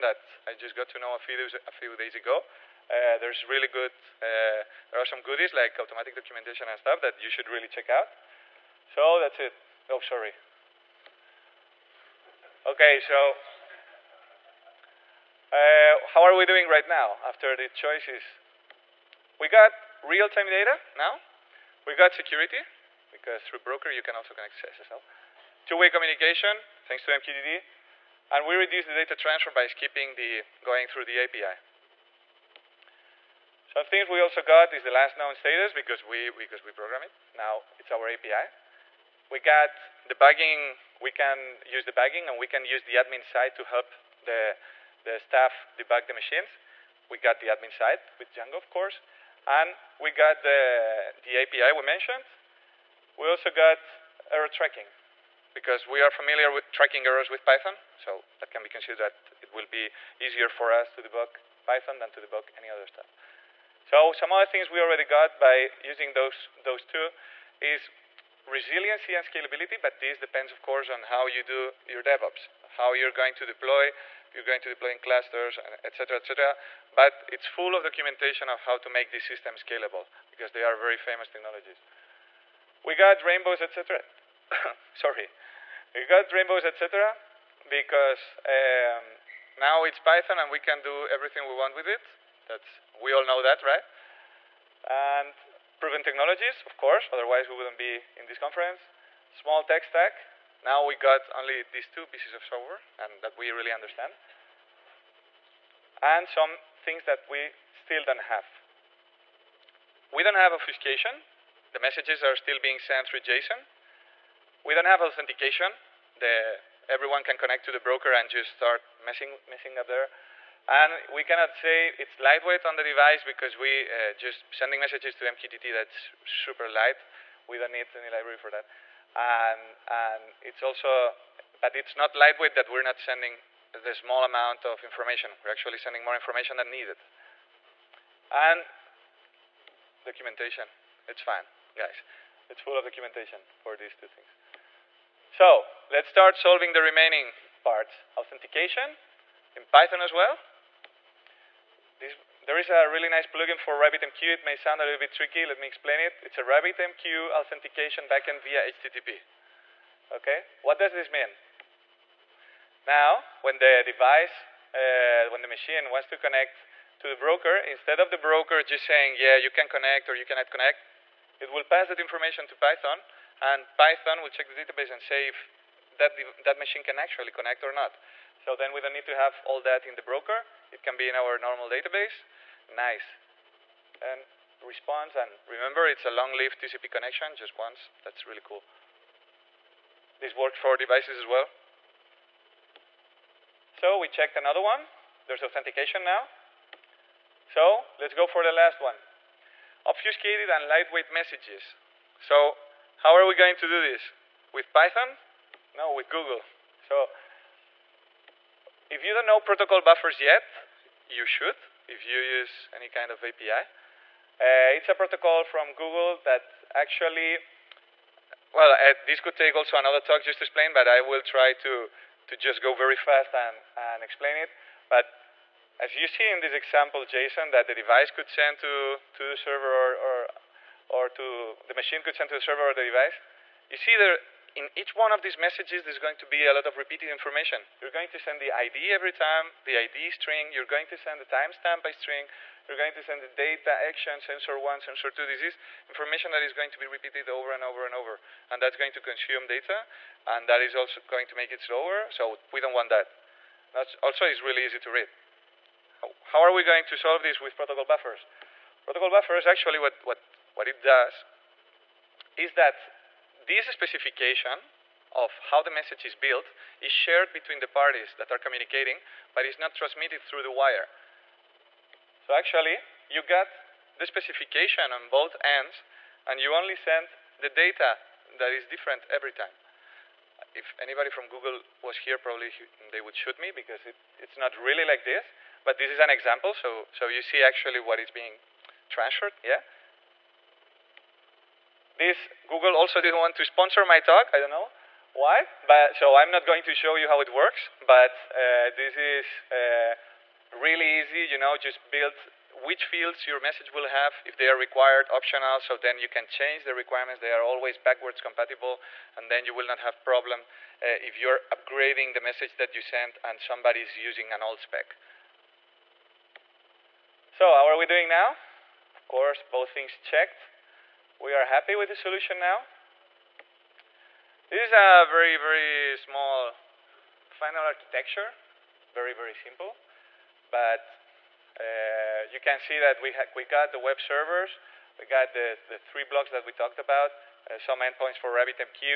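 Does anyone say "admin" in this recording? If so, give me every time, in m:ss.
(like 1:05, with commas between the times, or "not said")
0:42, 0:47.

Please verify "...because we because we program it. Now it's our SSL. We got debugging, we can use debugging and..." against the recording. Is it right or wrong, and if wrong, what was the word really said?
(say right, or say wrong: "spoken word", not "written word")
wrong: "API", not "SSL".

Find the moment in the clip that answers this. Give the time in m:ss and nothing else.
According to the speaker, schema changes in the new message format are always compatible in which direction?
5:07.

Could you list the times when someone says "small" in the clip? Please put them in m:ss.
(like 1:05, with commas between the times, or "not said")
1:39, 2:13, 5:25.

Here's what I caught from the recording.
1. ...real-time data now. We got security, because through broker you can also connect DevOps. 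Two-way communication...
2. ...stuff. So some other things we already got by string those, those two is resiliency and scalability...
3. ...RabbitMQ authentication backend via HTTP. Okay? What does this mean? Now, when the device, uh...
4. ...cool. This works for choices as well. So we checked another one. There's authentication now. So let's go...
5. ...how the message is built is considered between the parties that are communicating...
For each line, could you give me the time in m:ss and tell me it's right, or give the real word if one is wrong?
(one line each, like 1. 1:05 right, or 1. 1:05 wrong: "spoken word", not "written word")
1. 0:20 wrong: "SSL", not "DevOps"
2. 1:02 wrong: "using", not "string"
3. 2:36 right
4. 3:08 wrong: "devices", not "choices"
5. 4:25 wrong: "shared", not "considered".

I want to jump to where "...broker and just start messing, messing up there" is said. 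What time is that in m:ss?
1:57.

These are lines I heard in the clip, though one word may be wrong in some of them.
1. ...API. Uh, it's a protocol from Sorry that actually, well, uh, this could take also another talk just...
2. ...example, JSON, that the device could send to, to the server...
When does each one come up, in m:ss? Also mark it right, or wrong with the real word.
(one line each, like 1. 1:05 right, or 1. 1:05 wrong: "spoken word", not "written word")
1. 3:33 wrong: "Google", not "Sorry"
2. 3:46 right.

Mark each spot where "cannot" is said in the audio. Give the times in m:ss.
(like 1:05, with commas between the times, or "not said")
2:01, 2:50.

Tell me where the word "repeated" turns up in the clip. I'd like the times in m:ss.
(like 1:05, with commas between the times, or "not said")
3:56, 4:06.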